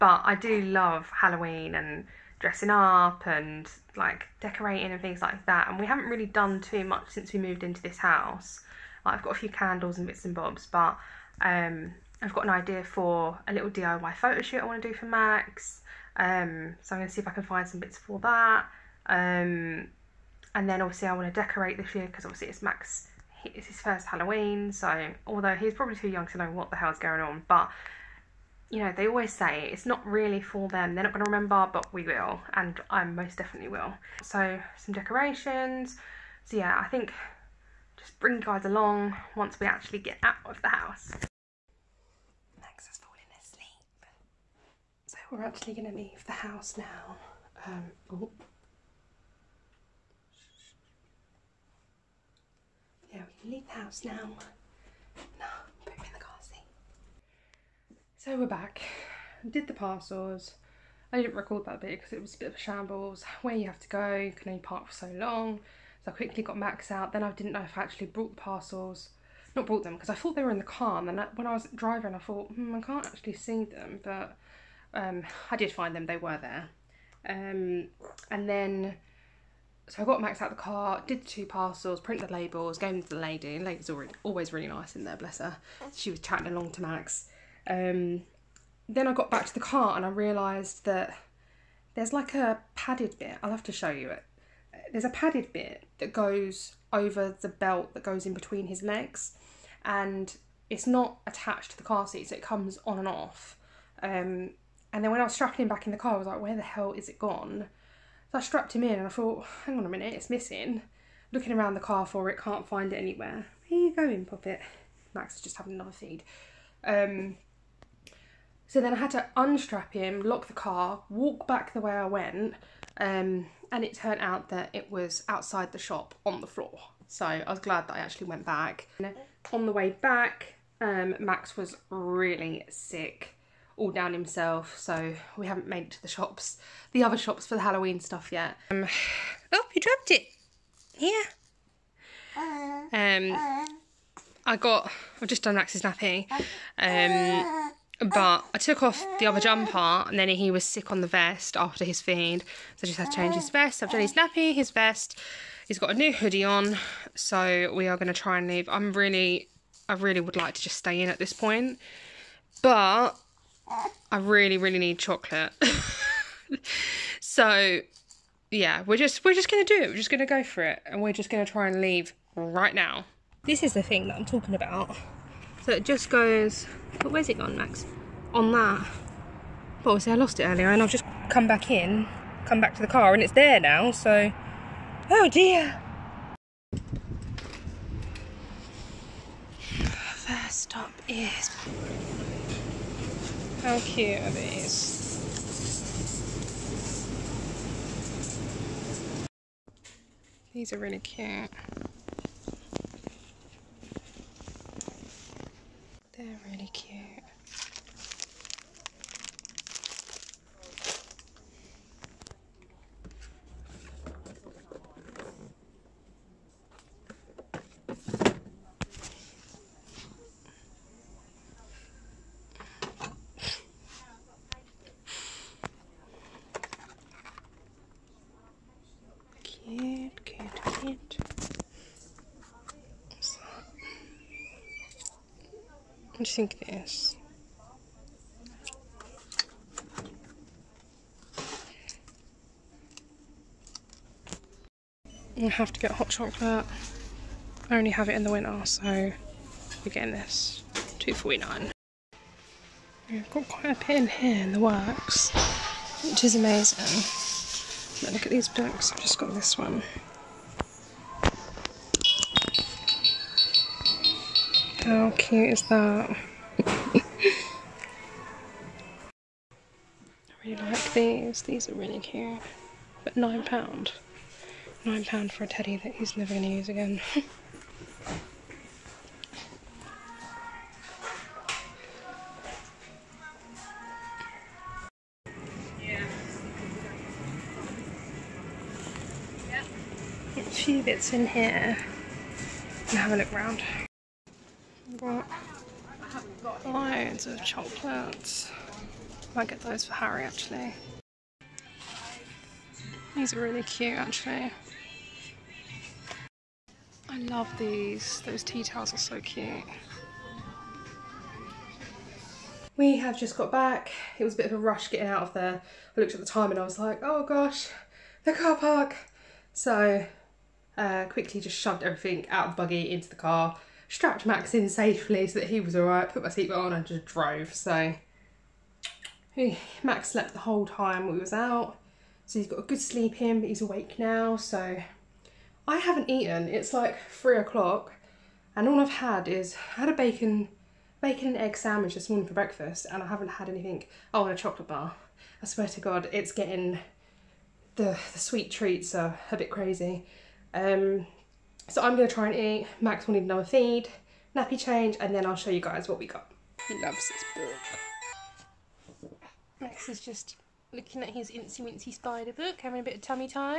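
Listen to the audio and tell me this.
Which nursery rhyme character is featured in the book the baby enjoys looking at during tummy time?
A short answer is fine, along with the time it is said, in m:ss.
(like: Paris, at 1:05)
Incy Wincy Spider, at 6:01.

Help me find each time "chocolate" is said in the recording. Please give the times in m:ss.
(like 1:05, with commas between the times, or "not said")
2:44, 4:06, 4:57, 5:44.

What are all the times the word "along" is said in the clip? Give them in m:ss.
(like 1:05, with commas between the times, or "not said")
0:38, 1:26.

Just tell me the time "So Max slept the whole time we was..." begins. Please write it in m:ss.
5:27.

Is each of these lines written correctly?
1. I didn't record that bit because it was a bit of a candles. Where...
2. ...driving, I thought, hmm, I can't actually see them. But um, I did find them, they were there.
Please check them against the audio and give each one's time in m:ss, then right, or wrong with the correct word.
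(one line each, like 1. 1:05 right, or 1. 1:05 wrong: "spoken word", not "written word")
1. 1:01 wrong: "shambles", not "candles"
2. 1:11 right.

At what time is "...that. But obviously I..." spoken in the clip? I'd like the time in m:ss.
2:58.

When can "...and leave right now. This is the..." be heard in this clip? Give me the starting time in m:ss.
2:51.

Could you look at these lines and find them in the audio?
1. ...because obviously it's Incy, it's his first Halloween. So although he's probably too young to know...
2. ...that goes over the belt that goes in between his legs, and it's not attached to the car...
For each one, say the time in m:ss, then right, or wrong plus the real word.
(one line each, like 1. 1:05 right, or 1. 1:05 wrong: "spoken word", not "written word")
1. 0:22 wrong: "Max", not "Incy"
2. 1:35 right.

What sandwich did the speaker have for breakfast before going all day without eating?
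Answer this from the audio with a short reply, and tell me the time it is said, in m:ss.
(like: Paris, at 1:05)
Bacon and egg, at 5:40.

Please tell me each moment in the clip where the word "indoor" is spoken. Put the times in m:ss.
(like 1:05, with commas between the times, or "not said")
not said.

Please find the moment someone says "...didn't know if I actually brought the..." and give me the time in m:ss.
1:07.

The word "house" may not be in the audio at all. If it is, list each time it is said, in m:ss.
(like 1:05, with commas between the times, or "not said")
0:07, 0:40, 0:46, 0:53.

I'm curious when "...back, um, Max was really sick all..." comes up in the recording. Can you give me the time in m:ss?
2:09.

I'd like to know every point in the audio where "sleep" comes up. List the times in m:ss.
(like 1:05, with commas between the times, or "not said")
5:32.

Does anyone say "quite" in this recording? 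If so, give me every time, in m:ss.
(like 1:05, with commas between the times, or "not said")
4:13.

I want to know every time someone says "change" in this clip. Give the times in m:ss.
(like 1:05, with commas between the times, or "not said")
2:33, 5:54.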